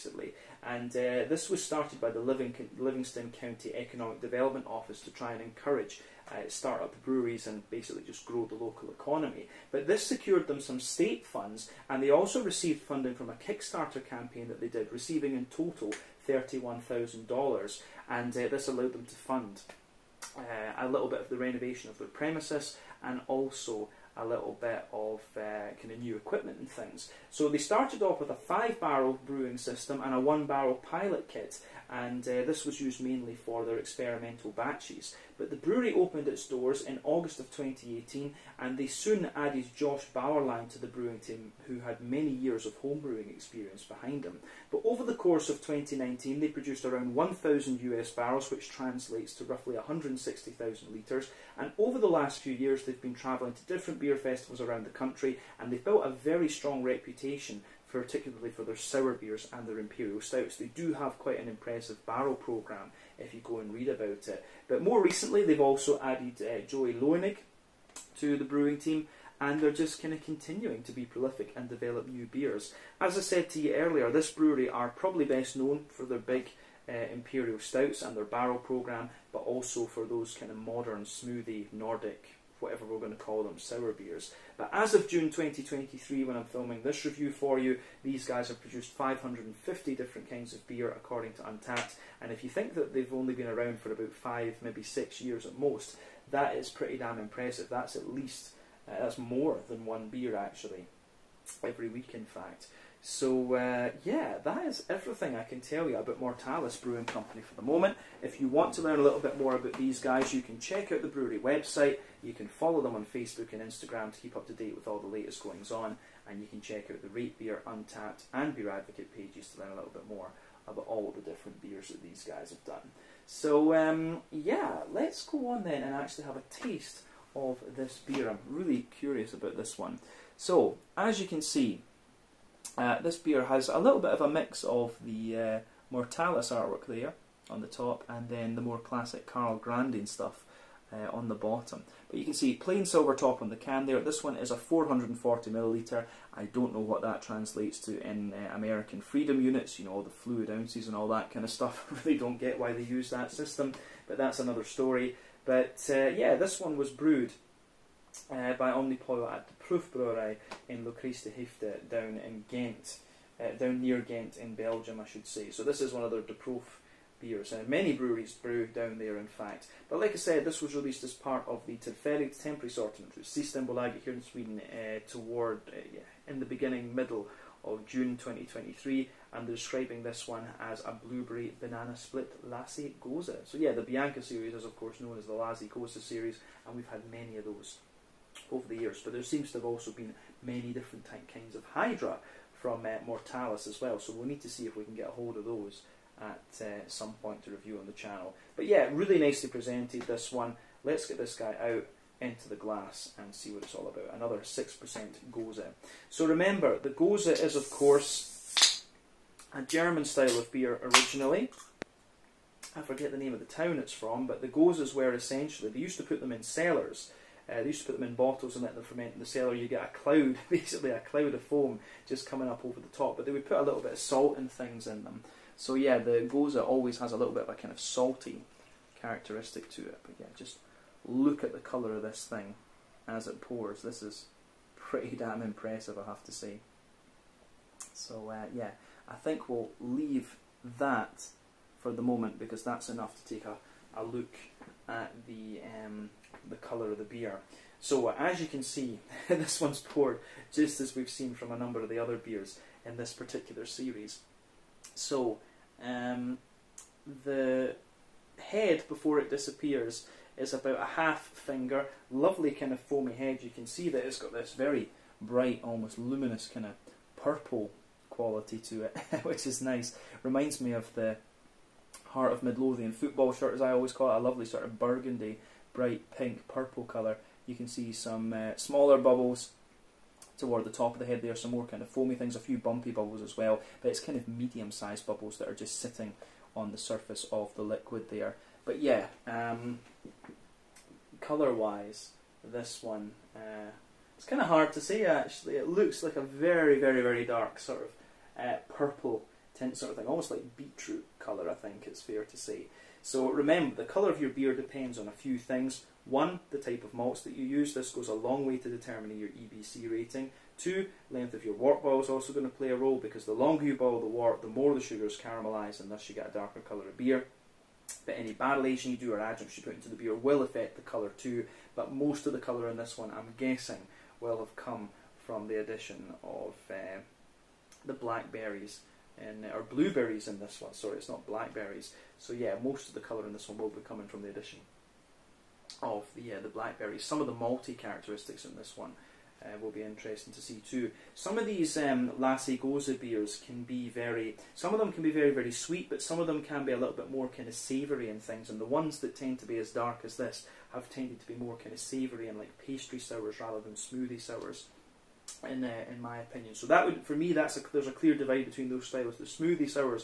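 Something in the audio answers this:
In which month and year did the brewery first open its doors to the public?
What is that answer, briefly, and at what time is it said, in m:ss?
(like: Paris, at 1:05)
August 2018, at 0:37.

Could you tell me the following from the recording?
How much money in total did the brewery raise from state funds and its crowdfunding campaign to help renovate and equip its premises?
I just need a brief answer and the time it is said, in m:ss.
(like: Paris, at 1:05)
$31,000, at 0:16.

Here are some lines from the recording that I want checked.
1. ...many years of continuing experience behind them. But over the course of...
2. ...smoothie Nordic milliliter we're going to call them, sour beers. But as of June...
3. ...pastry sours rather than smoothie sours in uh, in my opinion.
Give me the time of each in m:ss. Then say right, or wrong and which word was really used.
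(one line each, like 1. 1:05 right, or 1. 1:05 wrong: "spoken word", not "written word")
1. 0:42 wrong: "homebrewing", not "continuing"
2. 1:21 wrong: "whatever", not "milliliter"
3. 5:52 right.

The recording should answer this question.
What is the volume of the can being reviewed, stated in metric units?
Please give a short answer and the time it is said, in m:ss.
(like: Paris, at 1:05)
440 milliliters, at 2:24.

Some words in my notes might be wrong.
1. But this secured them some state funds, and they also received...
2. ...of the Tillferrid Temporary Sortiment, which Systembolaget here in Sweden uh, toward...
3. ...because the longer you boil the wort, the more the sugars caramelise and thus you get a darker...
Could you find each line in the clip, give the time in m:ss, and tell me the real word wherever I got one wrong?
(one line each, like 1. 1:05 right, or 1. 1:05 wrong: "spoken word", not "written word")
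1. 0:09 right
2. 2:51 right
3. 5:12 right.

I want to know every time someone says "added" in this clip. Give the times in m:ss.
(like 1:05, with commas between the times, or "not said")
0:39, 1:06.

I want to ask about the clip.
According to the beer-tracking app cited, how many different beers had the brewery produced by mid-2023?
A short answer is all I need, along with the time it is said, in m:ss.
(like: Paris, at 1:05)
550, at 1:28.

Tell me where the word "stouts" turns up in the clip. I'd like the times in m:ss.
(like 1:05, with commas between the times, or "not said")
1:00, 1:17.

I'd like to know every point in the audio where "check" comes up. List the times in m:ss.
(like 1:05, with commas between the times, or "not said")
1:50, 1:56.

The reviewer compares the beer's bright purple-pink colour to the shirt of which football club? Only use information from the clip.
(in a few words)
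Heart of Midlothian.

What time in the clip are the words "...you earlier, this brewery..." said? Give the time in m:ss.
1:13.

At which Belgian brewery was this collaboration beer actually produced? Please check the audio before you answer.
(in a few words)
Proef Brewery.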